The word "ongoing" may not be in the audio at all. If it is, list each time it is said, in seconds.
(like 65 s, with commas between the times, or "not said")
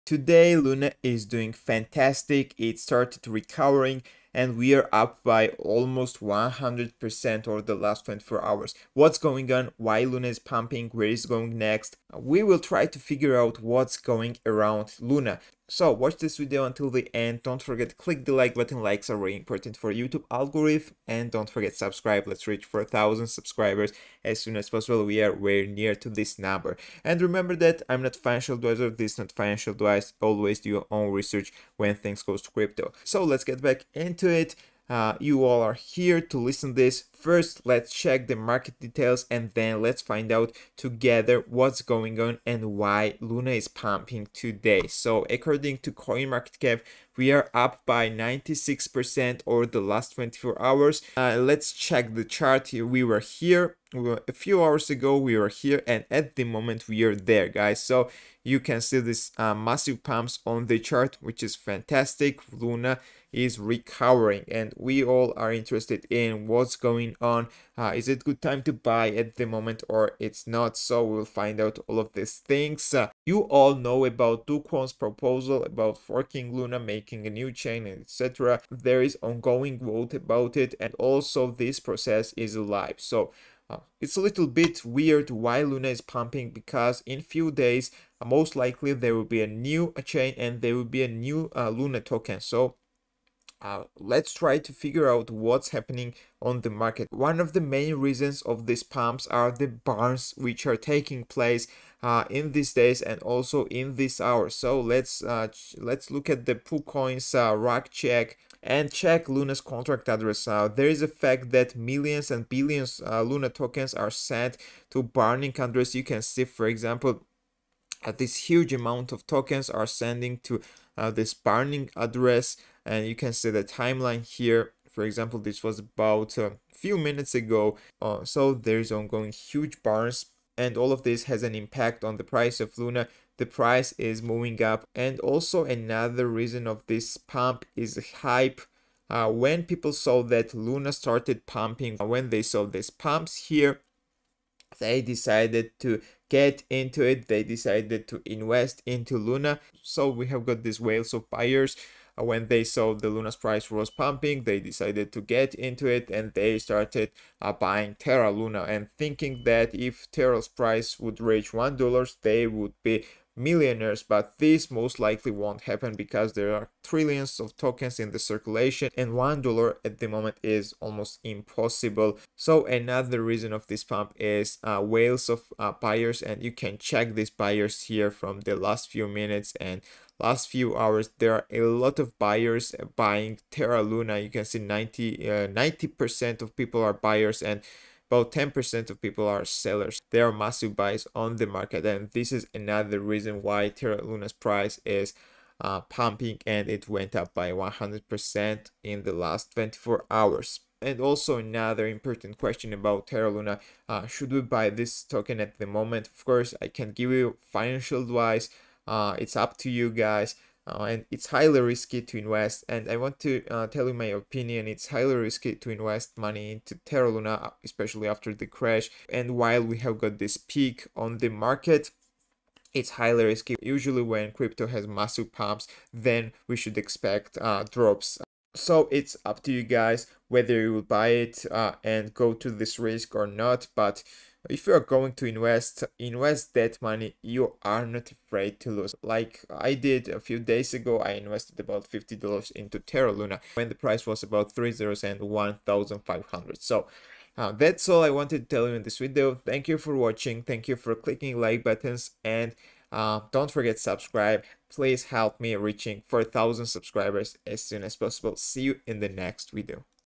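79 s, 128 s.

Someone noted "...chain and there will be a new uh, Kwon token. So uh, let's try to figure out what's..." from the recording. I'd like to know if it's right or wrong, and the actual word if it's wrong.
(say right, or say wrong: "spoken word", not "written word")
wrong: "Luna", not "Kwon".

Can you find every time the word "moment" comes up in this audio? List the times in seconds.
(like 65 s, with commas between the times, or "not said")
56 s, 69 s, 170 s, 205 s.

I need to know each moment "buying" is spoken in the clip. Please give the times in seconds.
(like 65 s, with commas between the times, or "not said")
157 s, 182 s.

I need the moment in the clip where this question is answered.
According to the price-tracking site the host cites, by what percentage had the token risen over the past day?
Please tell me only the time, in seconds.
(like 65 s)
48 s.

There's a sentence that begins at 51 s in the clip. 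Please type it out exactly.
Uh, let's check the chart here.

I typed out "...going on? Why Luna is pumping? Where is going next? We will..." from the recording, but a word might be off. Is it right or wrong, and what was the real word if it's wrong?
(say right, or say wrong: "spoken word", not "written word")
right.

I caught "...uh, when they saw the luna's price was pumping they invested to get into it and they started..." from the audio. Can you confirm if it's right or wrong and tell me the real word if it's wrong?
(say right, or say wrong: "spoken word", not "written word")
wrong: "decided", not "invested".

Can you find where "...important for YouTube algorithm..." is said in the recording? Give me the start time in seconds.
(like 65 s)
19 s.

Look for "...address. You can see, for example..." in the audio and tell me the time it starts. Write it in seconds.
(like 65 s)
115 s.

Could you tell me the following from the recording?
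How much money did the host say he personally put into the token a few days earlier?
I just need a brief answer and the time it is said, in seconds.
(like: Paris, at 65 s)
$50, at 241 s.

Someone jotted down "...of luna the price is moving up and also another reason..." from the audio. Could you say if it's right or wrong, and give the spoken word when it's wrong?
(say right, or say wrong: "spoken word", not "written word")
right.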